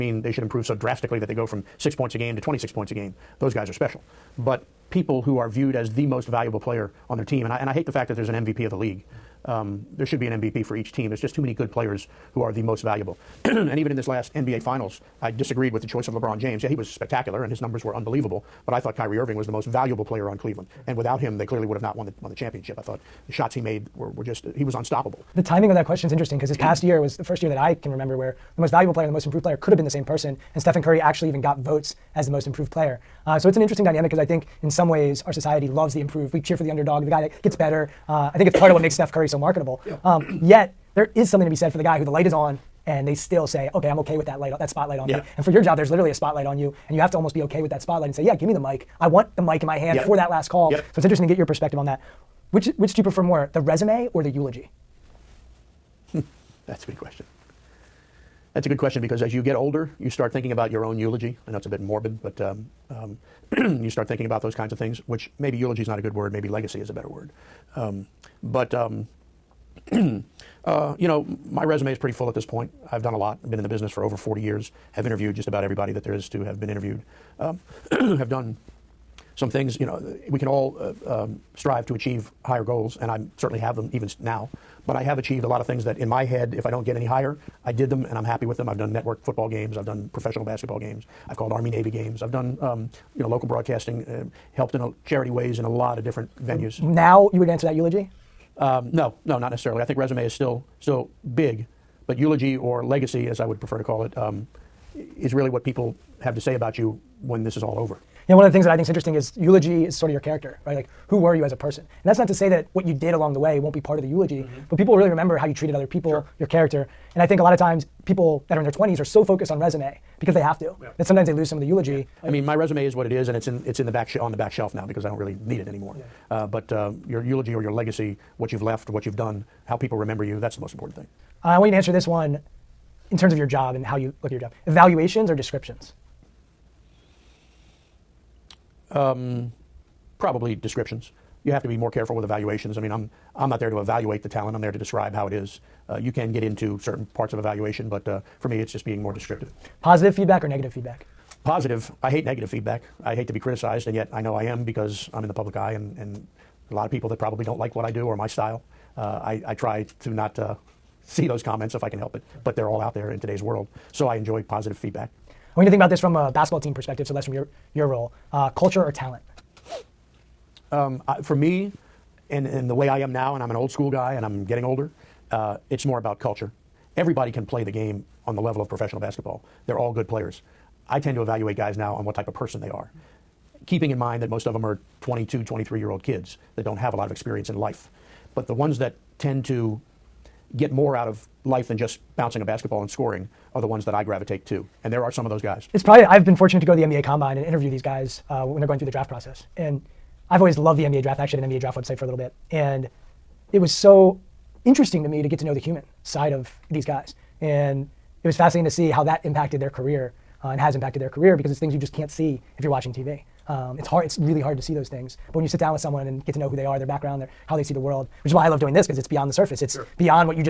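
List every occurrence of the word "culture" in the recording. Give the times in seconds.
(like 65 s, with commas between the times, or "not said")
168 s, 176 s.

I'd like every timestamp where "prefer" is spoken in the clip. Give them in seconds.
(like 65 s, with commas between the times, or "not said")
53 s, 103 s.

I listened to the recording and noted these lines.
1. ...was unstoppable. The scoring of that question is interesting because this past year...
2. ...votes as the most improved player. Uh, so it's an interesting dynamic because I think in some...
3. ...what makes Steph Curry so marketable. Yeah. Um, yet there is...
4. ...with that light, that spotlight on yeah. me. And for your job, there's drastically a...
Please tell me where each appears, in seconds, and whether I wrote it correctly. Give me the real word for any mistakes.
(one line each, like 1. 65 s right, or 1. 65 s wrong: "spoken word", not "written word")
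1. 24 s wrong: "timing", not "scoring"
2. 31 s right
3. 38 s right
4. 44 s wrong: "literally", not "drastically".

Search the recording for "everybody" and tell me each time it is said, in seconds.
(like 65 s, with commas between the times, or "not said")
75 s, 176 s.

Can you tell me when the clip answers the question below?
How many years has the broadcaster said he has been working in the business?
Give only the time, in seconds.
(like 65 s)
74 s.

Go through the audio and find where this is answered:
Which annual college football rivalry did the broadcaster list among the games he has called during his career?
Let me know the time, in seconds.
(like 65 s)
91 s.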